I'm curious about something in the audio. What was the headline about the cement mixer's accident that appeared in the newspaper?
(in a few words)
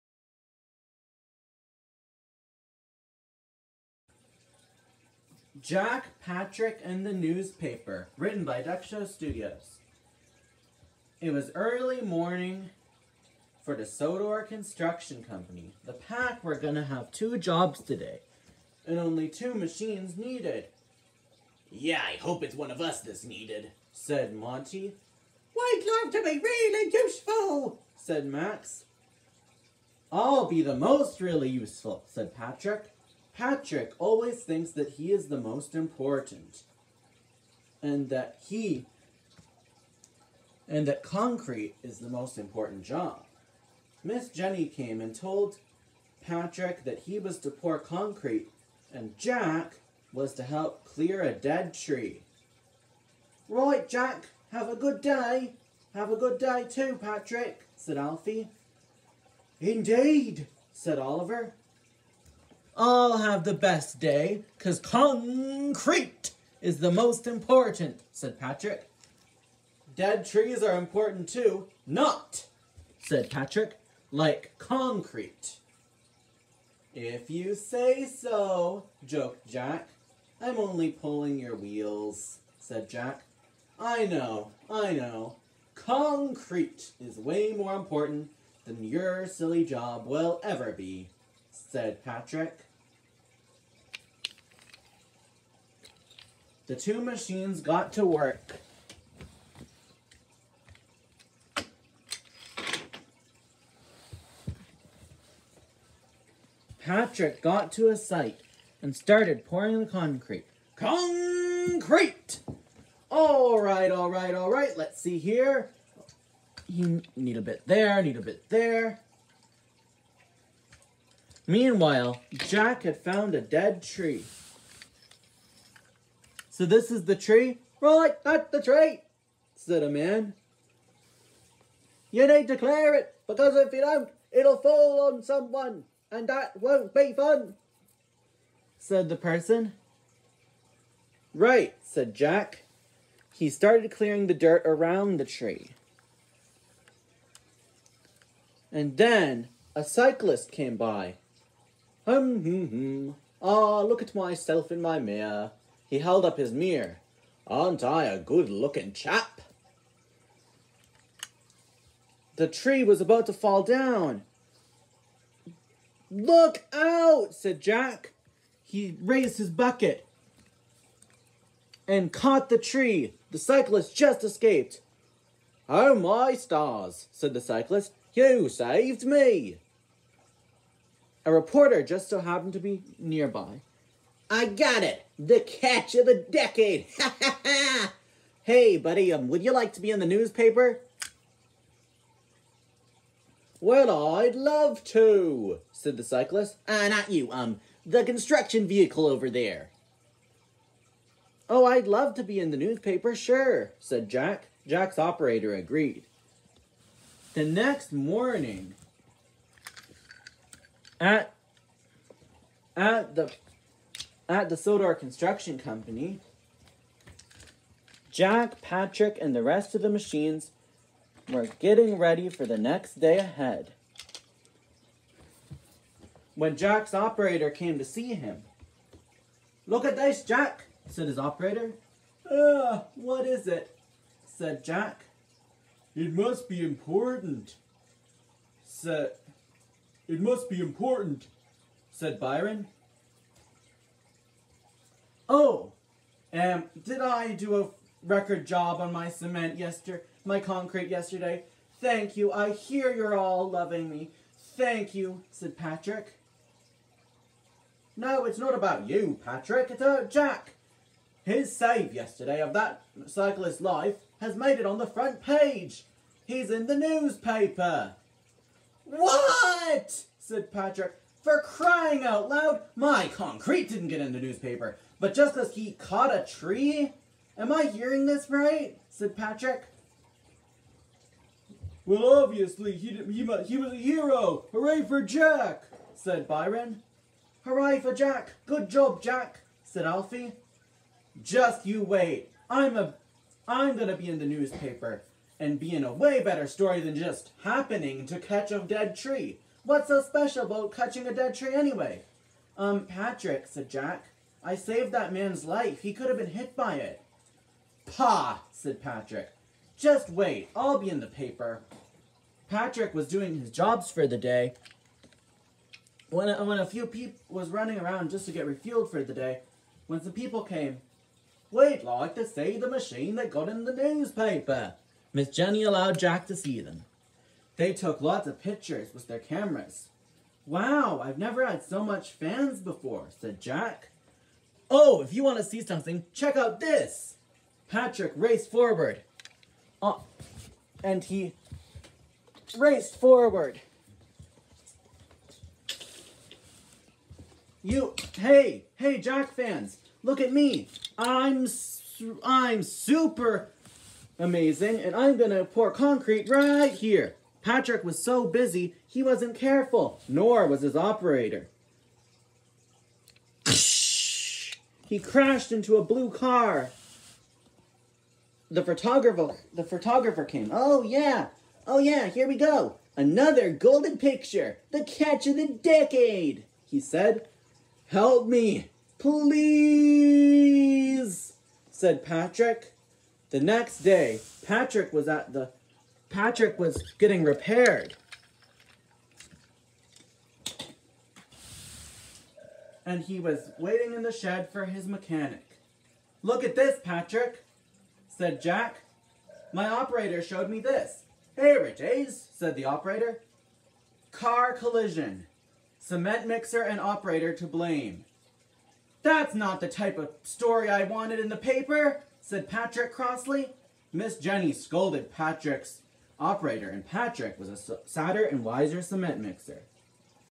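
Car collision.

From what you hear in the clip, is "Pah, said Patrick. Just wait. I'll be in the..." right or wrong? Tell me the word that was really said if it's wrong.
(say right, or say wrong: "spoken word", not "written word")
right.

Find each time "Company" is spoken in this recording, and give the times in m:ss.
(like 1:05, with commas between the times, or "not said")
0:15, 3:35.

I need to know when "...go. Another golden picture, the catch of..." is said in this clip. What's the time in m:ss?
6:12.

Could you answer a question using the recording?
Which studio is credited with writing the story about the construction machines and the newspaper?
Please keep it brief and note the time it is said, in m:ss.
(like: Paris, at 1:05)
Duck Show Studios, at 0:08.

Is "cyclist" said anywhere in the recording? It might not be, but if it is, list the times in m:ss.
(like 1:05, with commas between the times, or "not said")
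2:29, 2:53, 2:57, 3:16, 4:23.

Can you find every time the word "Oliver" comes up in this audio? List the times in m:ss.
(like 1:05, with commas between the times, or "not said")
1:00.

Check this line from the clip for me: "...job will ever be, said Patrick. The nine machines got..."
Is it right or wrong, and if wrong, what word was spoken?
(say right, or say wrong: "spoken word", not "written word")
wrong: "two", not "nine".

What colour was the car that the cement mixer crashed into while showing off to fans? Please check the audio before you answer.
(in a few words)
blue.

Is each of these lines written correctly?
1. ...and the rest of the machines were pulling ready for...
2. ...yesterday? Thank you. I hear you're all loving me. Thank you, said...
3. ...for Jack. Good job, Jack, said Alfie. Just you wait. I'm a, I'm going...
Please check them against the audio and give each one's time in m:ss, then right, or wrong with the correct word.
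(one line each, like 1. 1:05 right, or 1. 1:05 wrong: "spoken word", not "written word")
1. 3:39 wrong: "getting", not "pulling"
2. 4:10 right
3. 4:47 right.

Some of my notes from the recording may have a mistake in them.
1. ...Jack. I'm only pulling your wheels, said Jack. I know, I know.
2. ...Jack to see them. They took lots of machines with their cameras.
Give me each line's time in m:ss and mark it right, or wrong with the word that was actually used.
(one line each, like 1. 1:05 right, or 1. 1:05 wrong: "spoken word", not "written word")
1. 1:19 right
2. 5:25 wrong: "pictures", not "machines".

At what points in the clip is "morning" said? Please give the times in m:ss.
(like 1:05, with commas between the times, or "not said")
0:12, 3:27.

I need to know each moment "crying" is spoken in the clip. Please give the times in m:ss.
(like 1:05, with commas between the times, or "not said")
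4:31.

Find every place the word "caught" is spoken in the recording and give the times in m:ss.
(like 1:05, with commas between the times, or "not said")
2:52, 4:35.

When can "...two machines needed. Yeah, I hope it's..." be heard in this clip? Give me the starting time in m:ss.
0:19.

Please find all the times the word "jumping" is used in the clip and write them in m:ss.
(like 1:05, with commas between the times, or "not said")
not said.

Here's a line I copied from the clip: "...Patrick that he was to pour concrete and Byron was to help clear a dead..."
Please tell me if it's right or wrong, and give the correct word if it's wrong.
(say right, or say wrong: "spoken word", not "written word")
wrong: "Jack", not "Byron".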